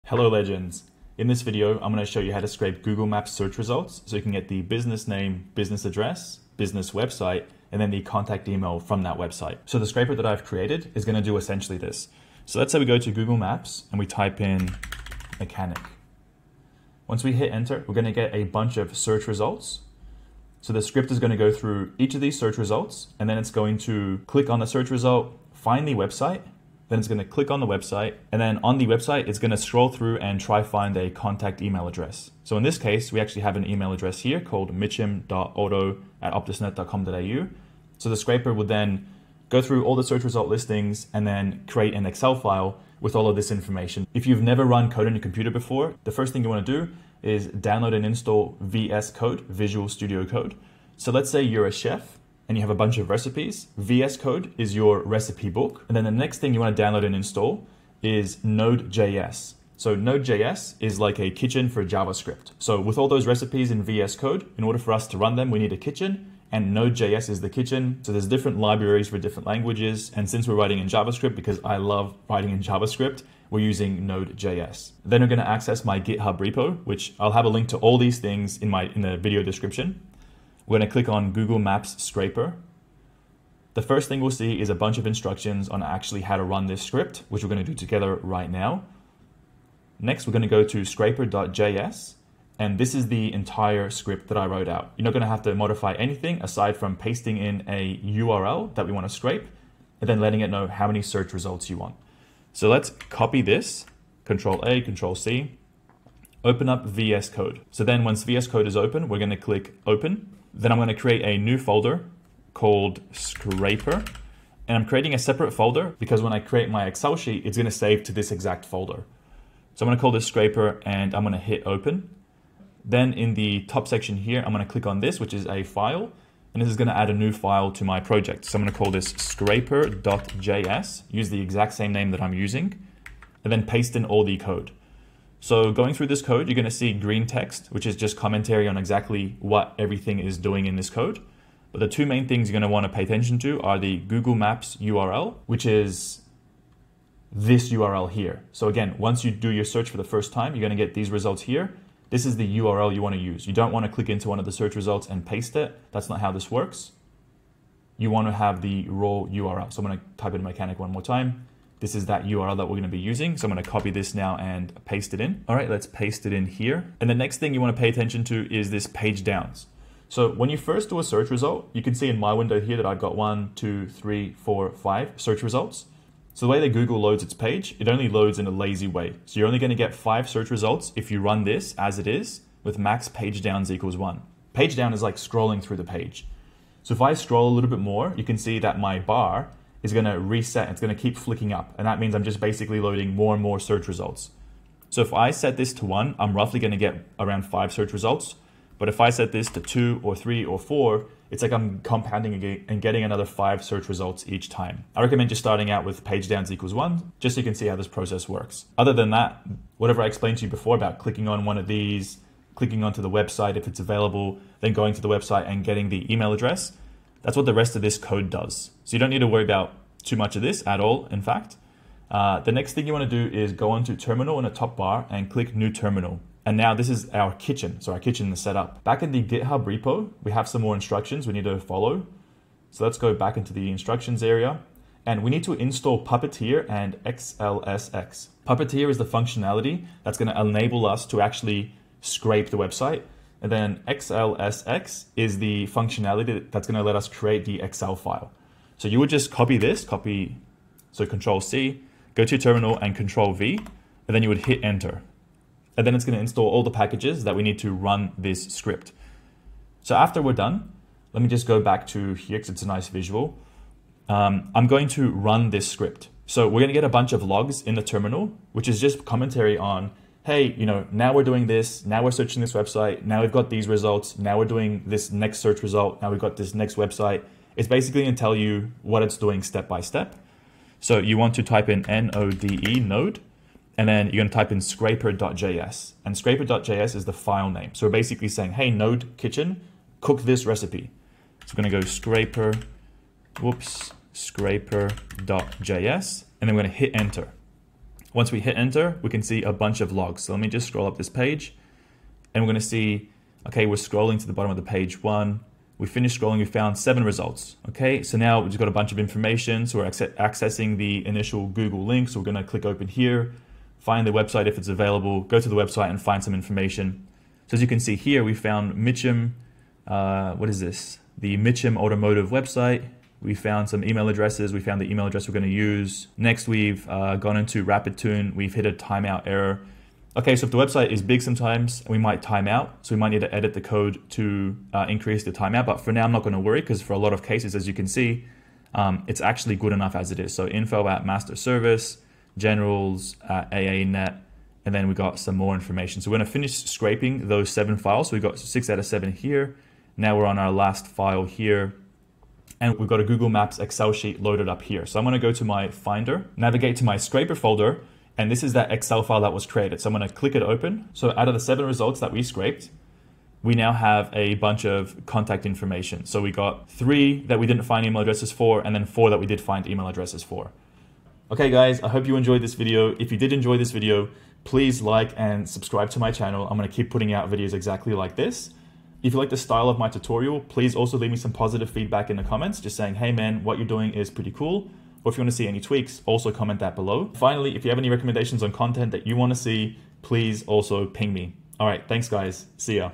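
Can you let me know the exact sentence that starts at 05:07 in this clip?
Okay, so now we've got a bunch of information.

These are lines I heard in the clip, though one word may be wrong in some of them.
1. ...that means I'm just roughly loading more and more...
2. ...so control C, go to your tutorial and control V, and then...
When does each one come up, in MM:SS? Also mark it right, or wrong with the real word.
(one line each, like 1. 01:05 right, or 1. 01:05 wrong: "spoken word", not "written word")
1. 03:11 wrong: "basically", not "roughly"
2. 04:10 wrong: "terminal", not "tutorial".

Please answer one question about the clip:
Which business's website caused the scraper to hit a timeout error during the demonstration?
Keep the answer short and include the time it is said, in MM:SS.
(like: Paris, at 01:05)
RapidTune, at 05:27.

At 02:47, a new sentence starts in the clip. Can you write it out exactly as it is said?
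And the next thing you wanna pay attention to is this page downs.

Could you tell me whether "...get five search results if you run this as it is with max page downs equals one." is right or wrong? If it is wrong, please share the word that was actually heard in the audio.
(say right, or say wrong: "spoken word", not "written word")
right.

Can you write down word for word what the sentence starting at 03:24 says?
I recommend just starting out with page downs equals one, just so you can see how this process works.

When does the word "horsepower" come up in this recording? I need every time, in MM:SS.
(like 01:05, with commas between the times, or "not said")
not said.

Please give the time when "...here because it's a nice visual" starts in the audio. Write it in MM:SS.
04:22.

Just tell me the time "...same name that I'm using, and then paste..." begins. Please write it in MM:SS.
02:11.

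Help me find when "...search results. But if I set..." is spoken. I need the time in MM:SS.
03:17.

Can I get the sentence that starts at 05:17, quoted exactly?
So as you can see here, we found Mitchum, uh, what is this?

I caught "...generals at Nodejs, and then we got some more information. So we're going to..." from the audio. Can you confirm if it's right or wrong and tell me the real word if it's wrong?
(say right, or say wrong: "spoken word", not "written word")
wrong: "Net", not "Nodejs".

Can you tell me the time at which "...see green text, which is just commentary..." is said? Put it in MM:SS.
02:16.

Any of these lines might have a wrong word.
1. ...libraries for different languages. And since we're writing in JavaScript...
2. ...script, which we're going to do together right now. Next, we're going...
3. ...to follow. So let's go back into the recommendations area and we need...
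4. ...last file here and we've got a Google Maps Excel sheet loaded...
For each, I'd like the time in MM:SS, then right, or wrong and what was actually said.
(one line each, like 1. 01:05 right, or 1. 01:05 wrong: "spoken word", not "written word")
1. 01:08 right
2. 01:26 right
3. 03:51 wrong: "instructions", not "recommendations"
4. 05:50 right.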